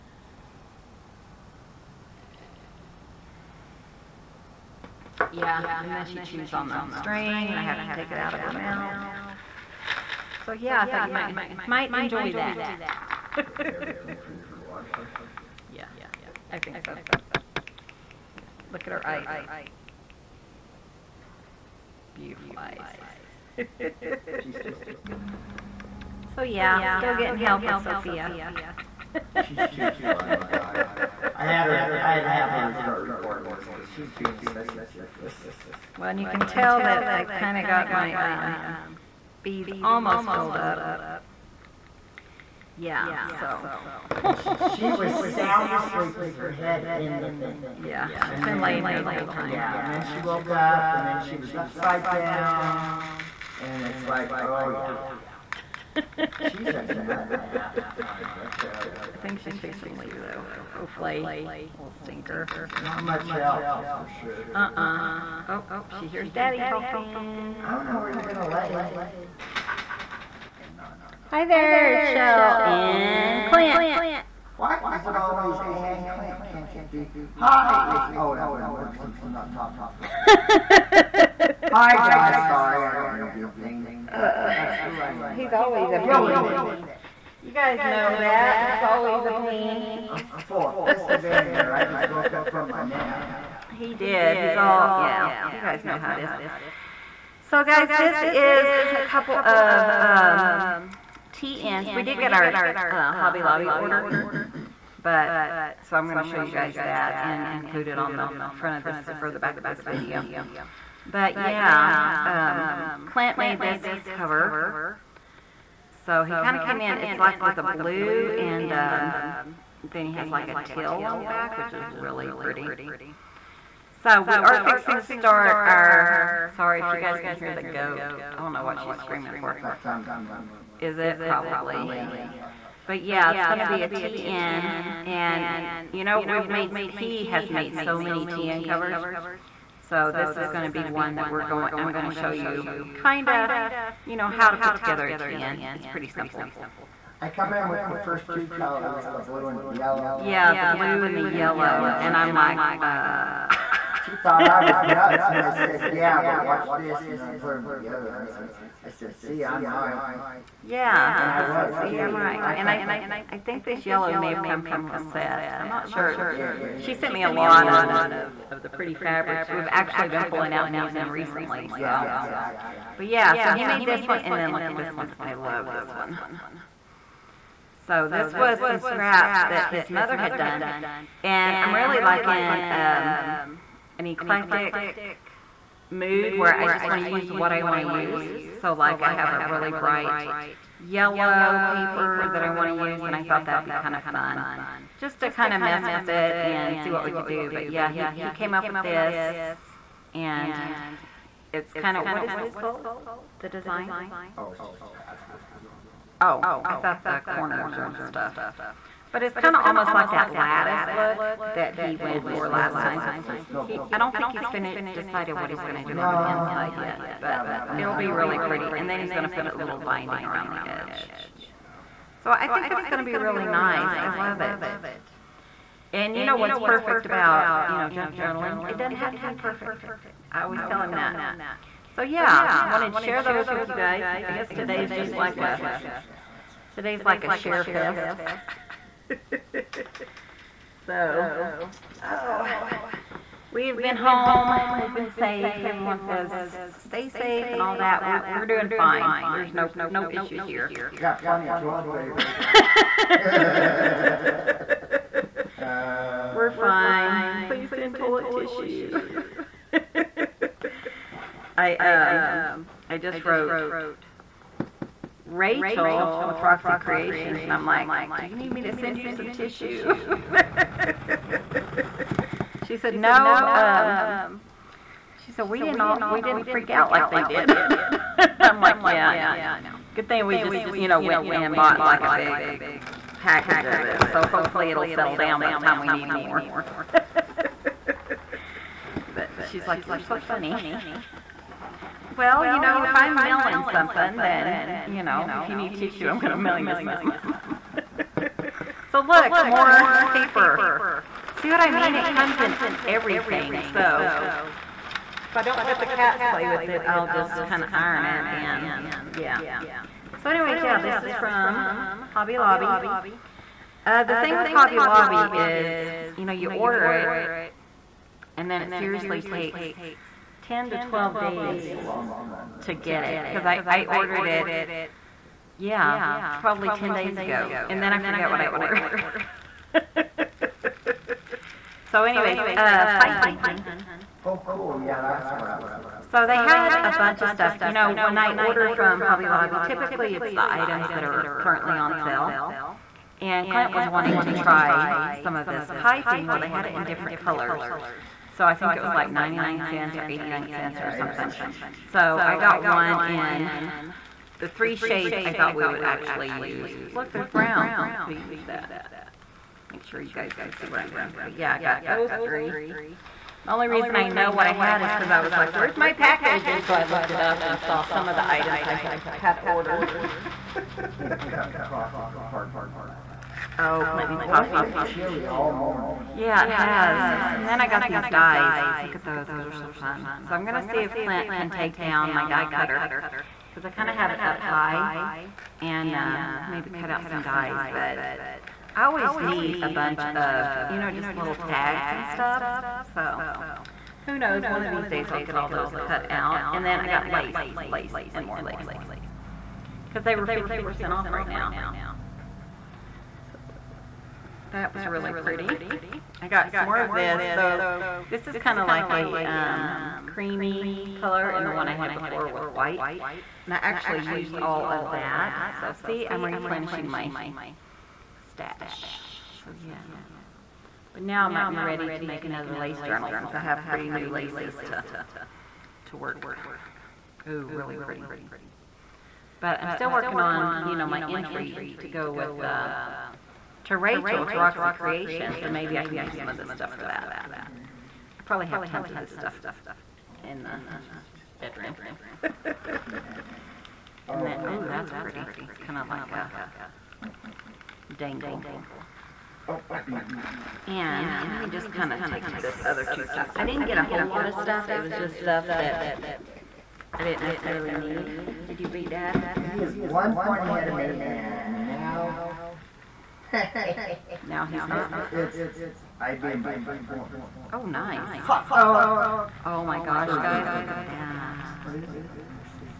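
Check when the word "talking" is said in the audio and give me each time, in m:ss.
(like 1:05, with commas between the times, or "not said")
1:06, 1:19.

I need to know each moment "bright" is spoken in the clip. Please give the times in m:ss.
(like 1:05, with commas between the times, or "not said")
3:09.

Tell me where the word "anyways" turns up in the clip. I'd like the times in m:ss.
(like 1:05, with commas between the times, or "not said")
5:10, 5:32.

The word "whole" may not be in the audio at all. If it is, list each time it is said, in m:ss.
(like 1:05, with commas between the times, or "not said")
0:49, 7:33.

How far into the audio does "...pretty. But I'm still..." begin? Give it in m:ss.
7:07.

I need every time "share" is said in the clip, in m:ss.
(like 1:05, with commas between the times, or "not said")
3:52, 3:57.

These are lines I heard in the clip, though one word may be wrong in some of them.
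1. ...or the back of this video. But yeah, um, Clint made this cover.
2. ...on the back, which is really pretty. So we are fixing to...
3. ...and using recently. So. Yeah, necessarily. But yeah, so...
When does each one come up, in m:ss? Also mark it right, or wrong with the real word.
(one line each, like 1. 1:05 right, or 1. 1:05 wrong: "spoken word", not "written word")
1. 1:49 right
2. 2:01 right
3. 2:50 wrong: "exactly", not "necessarily".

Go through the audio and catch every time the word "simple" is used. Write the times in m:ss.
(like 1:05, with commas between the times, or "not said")
2:26.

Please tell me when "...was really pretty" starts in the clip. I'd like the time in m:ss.
6:44.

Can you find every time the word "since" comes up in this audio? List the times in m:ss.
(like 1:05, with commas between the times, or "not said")
1:19, 7:03.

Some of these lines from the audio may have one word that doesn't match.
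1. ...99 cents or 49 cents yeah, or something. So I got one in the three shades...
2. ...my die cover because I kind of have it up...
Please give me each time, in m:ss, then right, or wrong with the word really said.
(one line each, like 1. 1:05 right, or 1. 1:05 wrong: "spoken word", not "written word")
1. 5:49 wrong: "89", not "49"
2. 6:22 wrong: "cutter", not "cover".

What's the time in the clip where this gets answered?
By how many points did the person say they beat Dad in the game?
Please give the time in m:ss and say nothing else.
7:46.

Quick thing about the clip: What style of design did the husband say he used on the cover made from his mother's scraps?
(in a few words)
Patchwork.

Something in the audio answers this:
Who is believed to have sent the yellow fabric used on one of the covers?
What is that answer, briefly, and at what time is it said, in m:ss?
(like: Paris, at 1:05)
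Lisette, at 2:44.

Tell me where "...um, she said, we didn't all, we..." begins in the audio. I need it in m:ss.
4:33.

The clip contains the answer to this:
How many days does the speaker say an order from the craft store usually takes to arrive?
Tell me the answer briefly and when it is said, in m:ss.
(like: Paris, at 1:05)
10 to 12 days, at 5:20.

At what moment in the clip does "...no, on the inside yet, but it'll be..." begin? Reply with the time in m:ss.
3:35.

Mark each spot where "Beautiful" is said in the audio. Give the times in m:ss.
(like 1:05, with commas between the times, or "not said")
0:22.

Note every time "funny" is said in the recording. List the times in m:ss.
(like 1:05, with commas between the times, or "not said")
0:30, 4:50.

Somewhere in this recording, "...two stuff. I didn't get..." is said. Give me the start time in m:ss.
7:32.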